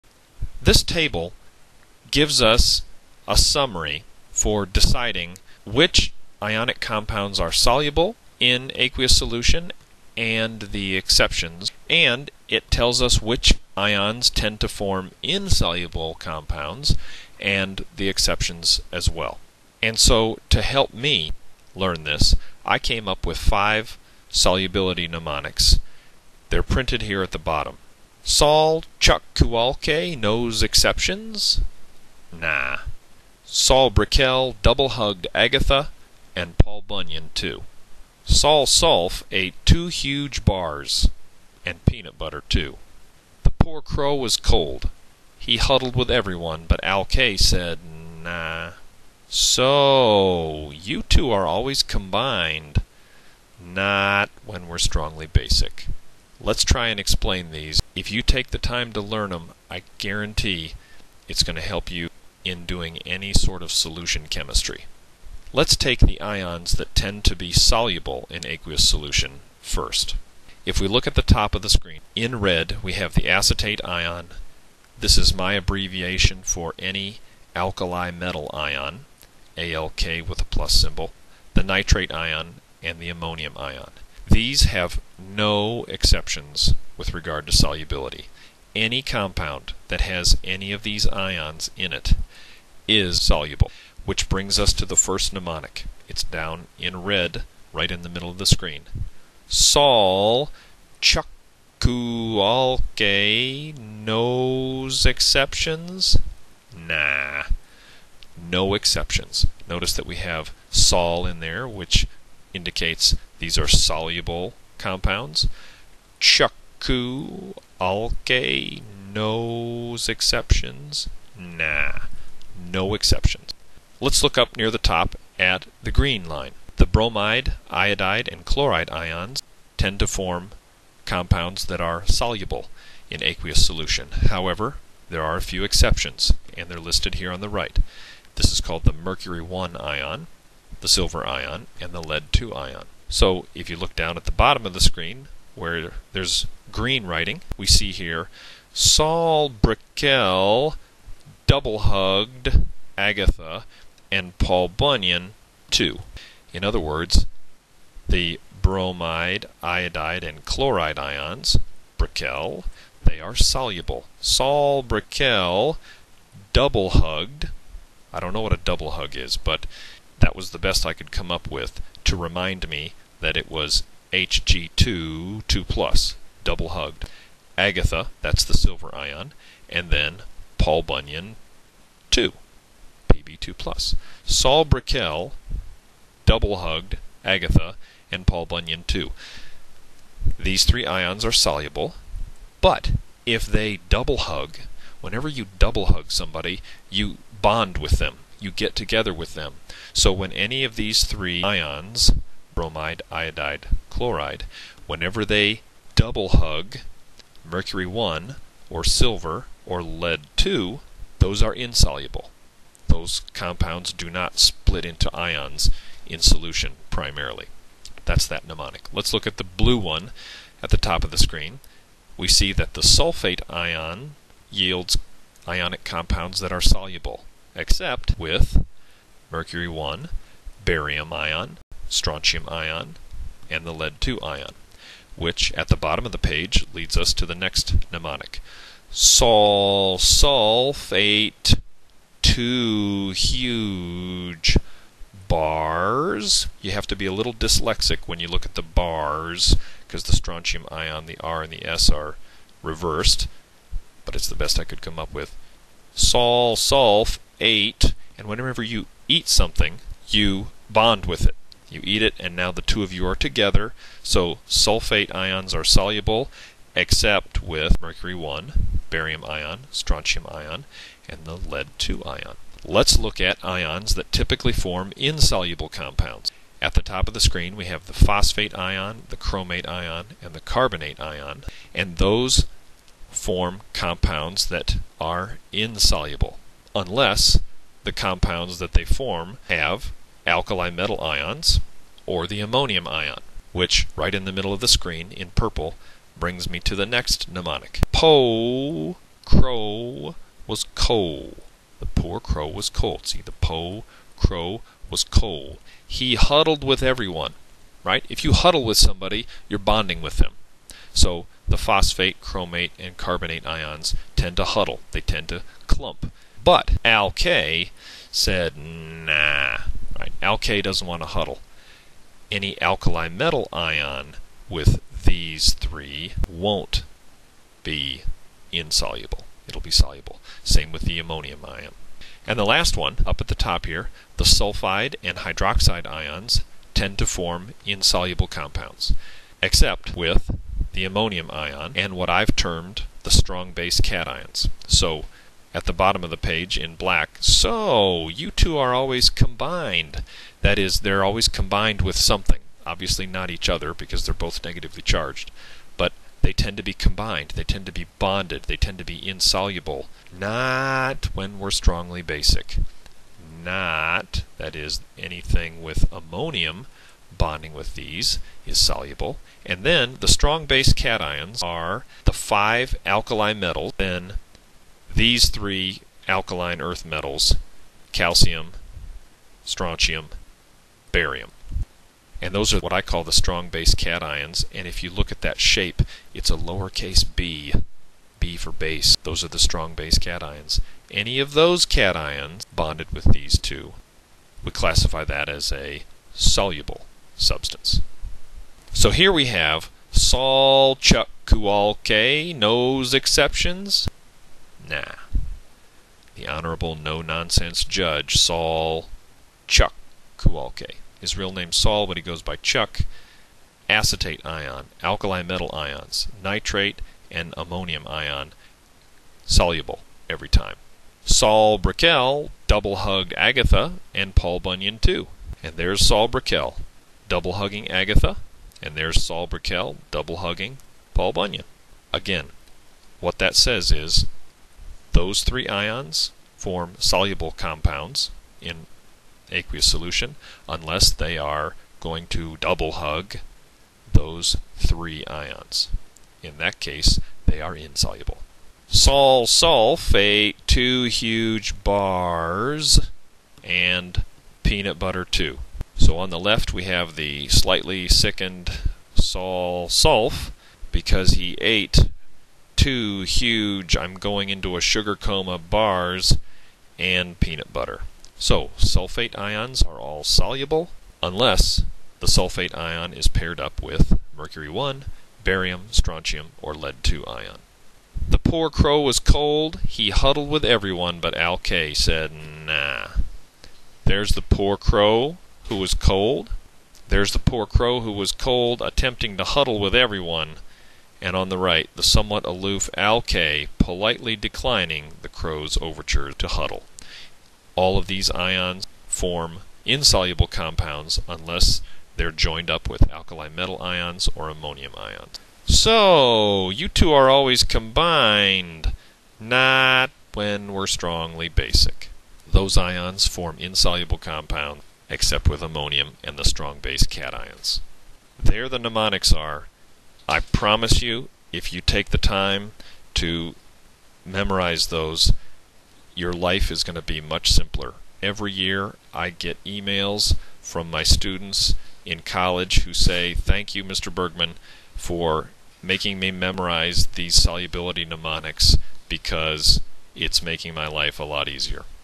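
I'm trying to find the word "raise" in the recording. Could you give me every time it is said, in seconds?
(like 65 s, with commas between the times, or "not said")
not said.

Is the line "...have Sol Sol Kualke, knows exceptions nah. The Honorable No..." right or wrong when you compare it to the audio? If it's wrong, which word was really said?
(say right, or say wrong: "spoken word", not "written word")
wrong: "Chuck", not "Sol".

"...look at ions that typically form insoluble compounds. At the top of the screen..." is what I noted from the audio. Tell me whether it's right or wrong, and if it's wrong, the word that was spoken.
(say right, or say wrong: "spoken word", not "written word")
right.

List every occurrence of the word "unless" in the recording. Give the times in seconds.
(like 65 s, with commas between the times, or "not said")
286 s, 440 s, 471 s, 501 s.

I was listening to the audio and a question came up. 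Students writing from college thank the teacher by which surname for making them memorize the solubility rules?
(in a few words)
Bergmann.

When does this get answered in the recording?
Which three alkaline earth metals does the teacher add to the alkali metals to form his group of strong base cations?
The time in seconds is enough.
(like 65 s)
377 s.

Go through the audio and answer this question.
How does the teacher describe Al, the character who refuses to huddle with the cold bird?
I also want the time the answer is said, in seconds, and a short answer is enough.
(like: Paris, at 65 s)
somewhat aloof, at 491 s.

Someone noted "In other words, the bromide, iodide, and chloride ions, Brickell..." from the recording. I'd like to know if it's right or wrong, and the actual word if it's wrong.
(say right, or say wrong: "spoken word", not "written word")
right.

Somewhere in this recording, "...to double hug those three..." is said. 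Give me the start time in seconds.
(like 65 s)
442 s.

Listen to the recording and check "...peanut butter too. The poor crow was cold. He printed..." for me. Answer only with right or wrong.
wrong.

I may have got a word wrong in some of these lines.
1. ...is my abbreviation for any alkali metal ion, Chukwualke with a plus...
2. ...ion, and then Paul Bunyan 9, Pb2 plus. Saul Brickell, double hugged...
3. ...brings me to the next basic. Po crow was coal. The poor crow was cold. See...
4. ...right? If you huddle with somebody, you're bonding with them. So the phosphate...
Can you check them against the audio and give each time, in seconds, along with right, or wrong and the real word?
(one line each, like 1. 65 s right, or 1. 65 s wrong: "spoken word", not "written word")
1. 75 s wrong: "ALK", not "Chukwualke"
2. 178 s wrong: "2", not "9"
3. 296 s wrong: "mnemonic", not "basic"
4. 307 s right.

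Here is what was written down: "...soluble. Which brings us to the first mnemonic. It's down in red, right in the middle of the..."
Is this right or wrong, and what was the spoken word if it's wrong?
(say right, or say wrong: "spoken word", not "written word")
right.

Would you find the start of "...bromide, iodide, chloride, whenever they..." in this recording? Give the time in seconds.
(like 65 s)
202 s.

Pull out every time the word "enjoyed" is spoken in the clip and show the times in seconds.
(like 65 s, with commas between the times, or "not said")
not said.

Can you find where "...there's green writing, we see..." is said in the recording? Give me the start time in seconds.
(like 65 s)
146 s.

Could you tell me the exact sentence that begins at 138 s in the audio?
This is called the mercury 1 ion, the silver ion, and the lead 2 ion.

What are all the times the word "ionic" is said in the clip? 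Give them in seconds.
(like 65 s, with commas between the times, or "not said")
6 s, 225 s.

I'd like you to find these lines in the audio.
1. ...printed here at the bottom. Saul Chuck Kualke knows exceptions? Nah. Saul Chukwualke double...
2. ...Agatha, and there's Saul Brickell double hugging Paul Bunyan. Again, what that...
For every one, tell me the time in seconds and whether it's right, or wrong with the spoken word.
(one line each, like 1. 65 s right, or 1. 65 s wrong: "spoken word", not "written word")
1. 26 s wrong: "Brickell", not "Chukwualke"
2. 427 s right.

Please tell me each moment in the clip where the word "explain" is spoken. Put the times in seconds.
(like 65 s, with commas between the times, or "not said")
56 s.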